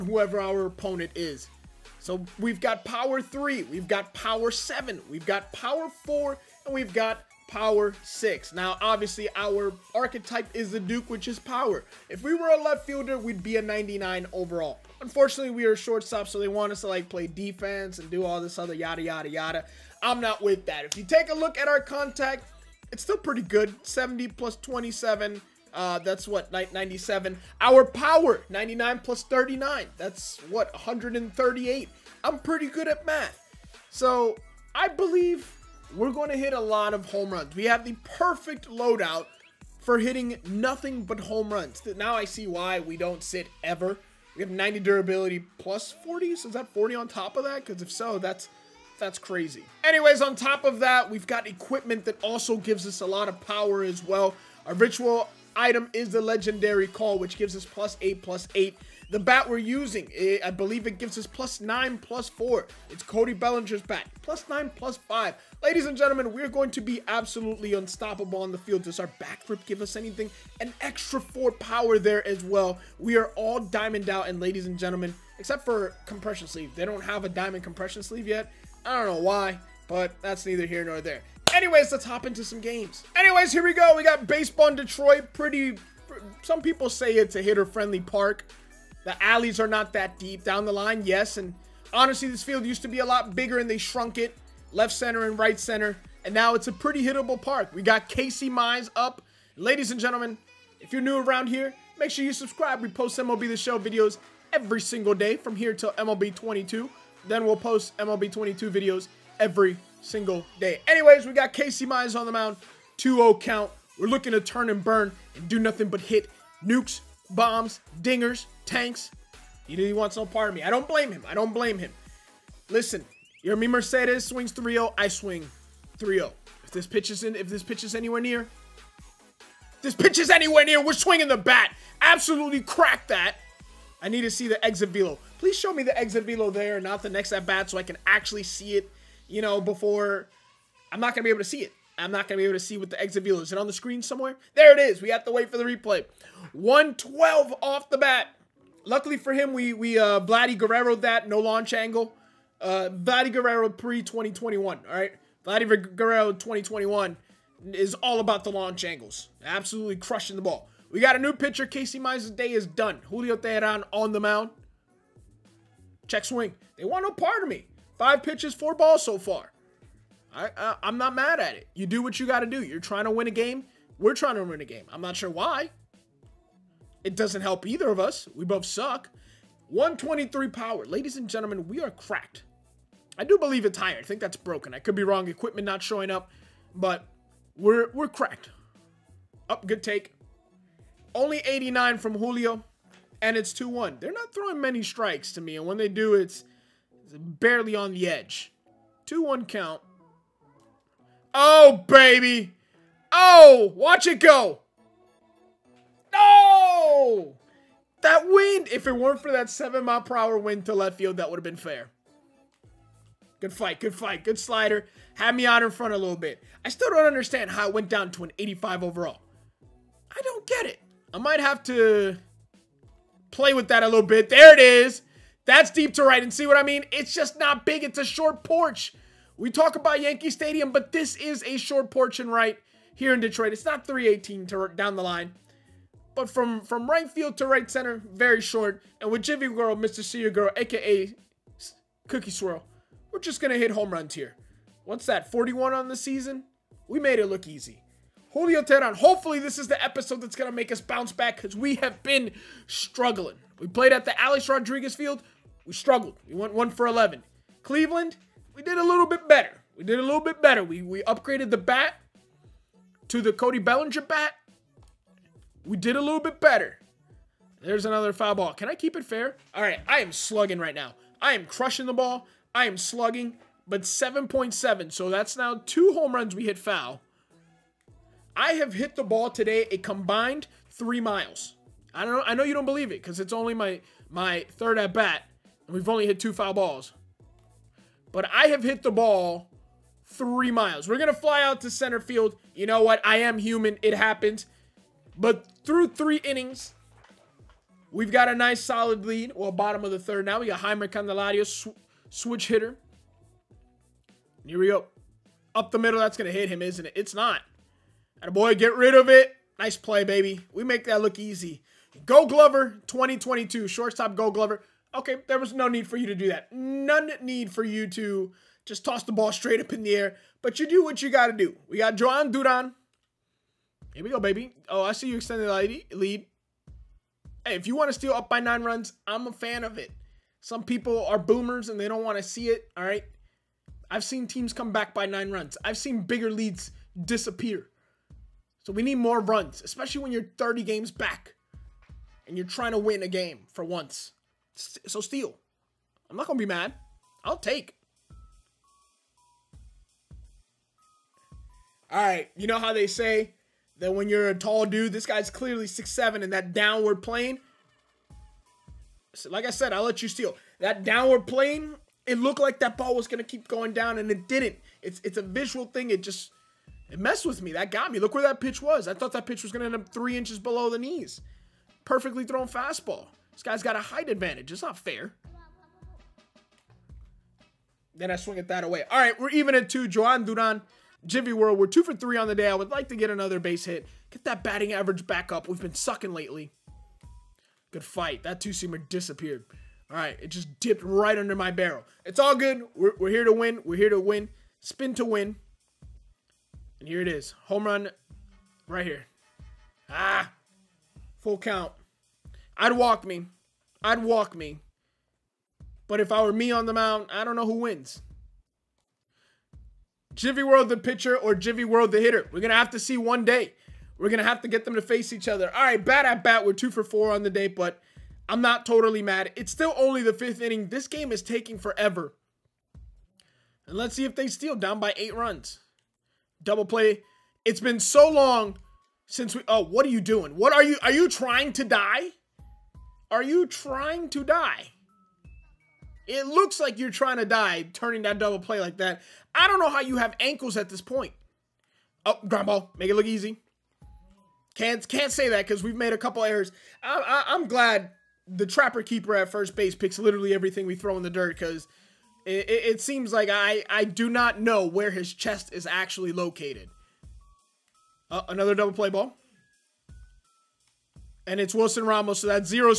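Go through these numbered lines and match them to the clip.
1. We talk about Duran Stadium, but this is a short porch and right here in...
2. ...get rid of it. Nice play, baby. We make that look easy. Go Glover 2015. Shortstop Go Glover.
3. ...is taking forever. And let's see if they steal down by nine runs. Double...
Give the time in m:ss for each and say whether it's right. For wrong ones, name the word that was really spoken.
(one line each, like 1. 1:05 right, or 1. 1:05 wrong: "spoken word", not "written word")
1. 3:49 wrong: "Yankee", not "Duran"
2. 5:08 wrong: "2022", not "2015"
3. 7:01 wrong: "eight", not "nine".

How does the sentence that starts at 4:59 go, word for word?
Well, bottom of the third now.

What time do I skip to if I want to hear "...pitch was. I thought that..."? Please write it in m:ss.
6:08.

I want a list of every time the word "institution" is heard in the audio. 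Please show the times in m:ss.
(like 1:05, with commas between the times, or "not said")
not said.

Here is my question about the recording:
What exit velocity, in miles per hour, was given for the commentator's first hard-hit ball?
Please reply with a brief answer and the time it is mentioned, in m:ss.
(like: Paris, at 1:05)
112, at 2:26.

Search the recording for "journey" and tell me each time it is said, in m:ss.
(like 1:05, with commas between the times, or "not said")
not said.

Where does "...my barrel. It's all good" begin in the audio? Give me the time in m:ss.
6:31.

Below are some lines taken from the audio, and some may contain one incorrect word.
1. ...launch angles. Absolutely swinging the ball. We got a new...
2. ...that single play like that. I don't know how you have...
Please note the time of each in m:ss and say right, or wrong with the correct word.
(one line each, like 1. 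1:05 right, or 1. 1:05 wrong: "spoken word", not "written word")
1. 2:38 wrong: "crushing", not "swinging"
2. 7:18 wrong: "double", not "single".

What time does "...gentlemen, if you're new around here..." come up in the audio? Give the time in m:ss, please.
1:40.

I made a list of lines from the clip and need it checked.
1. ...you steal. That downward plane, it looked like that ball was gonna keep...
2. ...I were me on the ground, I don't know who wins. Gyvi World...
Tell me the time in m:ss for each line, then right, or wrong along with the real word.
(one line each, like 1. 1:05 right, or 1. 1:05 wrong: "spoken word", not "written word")
1. 6:00 right
2. 6:46 wrong: "mound", not "ground".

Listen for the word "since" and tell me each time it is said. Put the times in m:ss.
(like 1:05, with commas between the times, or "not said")
7:09.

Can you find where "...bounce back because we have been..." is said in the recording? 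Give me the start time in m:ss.
4:10.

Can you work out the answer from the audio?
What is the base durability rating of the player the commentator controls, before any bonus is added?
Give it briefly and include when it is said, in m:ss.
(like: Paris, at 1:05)
90, at 0:44.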